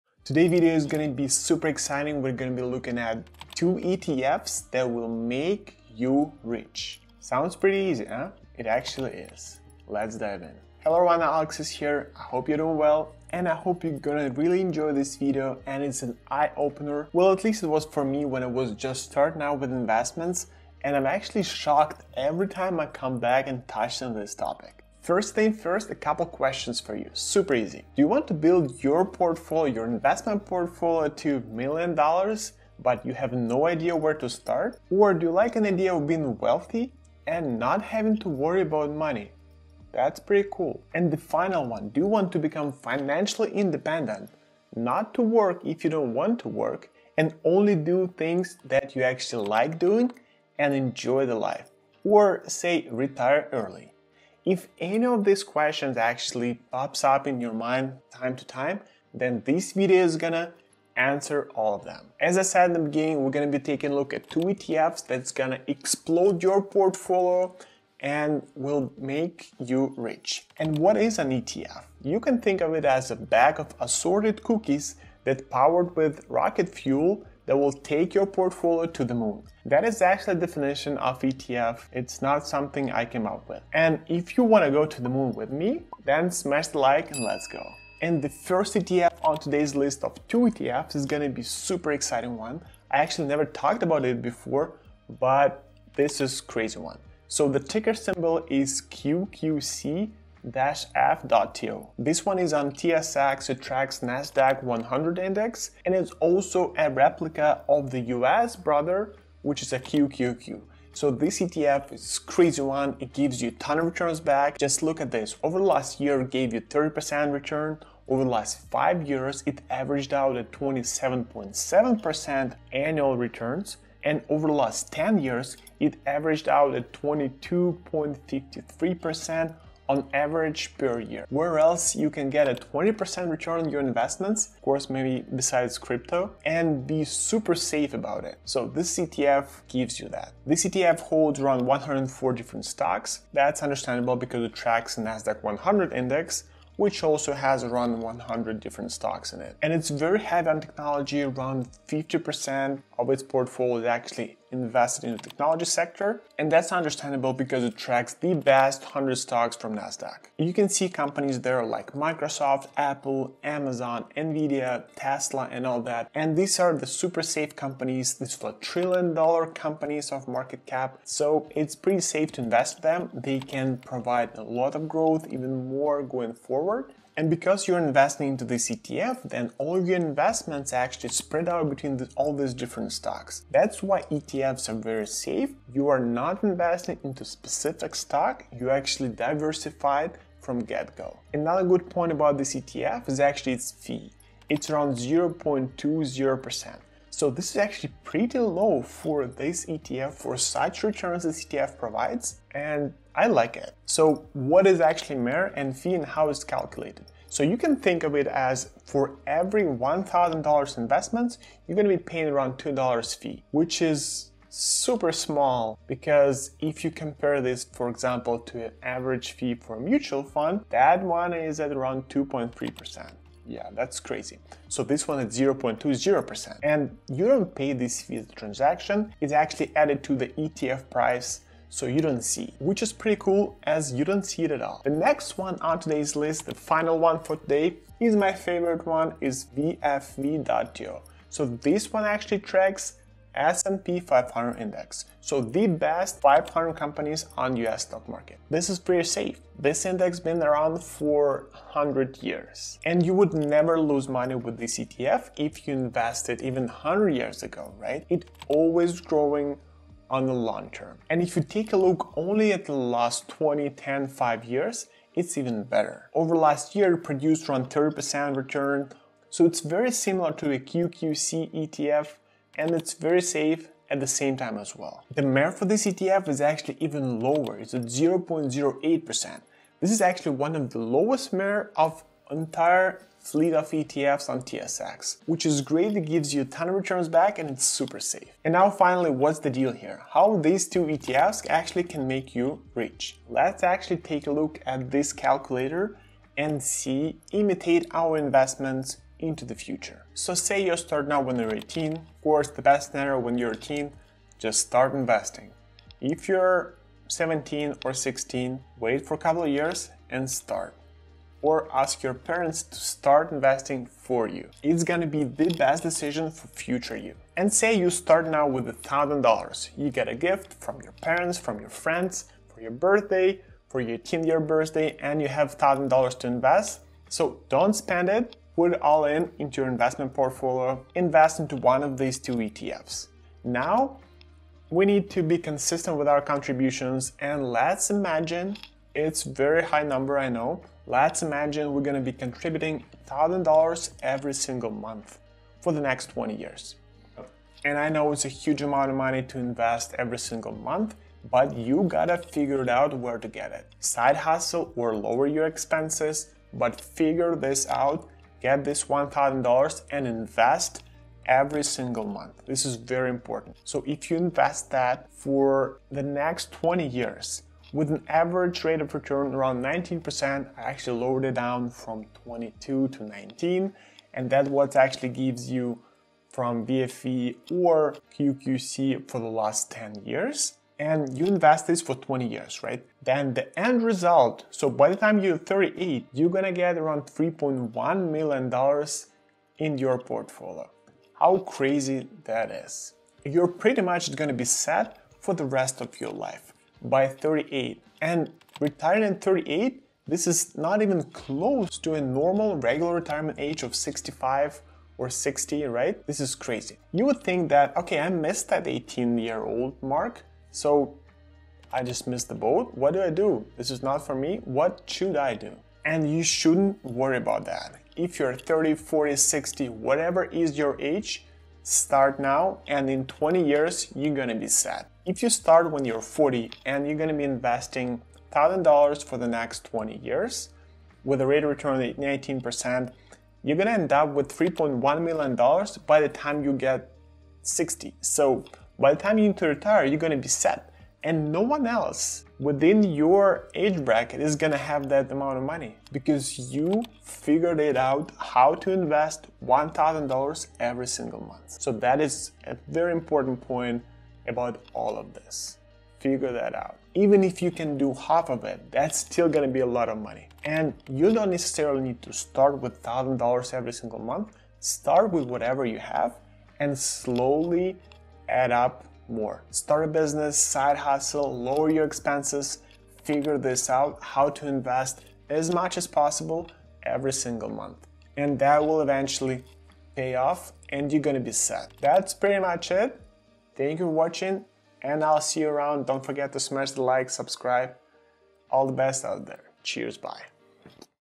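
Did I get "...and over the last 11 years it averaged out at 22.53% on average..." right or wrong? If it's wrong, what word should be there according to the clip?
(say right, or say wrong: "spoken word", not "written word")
wrong: "10", not "11".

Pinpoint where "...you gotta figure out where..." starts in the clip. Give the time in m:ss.
5:51.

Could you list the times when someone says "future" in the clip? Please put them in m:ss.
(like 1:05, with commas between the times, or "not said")
4:59, 5:16.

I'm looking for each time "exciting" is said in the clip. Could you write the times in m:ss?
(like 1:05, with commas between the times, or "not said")
0:01, 1:31.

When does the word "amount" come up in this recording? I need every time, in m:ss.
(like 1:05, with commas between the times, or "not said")
5:48, 7:25.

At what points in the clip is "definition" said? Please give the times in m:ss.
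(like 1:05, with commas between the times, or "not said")
1:20.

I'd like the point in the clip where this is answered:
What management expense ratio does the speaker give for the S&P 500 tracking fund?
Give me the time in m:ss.
4:37.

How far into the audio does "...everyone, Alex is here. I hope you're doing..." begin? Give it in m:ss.
0:10.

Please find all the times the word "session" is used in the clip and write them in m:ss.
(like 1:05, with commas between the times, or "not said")
not said.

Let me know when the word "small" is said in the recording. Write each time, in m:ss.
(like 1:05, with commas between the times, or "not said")
3:35.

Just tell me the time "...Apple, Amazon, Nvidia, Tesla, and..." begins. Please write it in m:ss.
2:42.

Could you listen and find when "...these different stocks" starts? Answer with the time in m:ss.
3:02.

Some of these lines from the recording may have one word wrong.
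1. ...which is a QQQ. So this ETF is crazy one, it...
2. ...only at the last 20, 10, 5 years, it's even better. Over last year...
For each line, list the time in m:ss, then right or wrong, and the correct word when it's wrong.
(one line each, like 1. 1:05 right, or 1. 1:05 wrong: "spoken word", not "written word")
1. 1:49 right
2. 4:22 right.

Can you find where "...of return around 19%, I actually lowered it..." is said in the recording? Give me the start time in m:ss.
6:08.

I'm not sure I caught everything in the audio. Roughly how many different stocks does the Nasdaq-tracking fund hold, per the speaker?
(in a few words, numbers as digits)
104.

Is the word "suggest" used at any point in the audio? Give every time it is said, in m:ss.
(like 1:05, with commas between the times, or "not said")
not said.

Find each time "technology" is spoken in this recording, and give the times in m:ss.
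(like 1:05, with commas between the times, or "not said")
2:30, 2:35.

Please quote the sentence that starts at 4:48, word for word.
And now finally, what's the deal here?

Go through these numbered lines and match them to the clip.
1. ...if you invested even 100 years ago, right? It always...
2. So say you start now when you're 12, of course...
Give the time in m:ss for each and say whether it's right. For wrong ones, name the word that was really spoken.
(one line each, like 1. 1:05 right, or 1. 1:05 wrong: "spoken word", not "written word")
1. 4:15 right
2. 5:00 wrong: "18", not "12".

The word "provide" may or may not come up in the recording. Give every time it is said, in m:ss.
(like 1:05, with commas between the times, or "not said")
2:53, 3:21.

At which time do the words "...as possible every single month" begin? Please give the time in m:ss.
7:55.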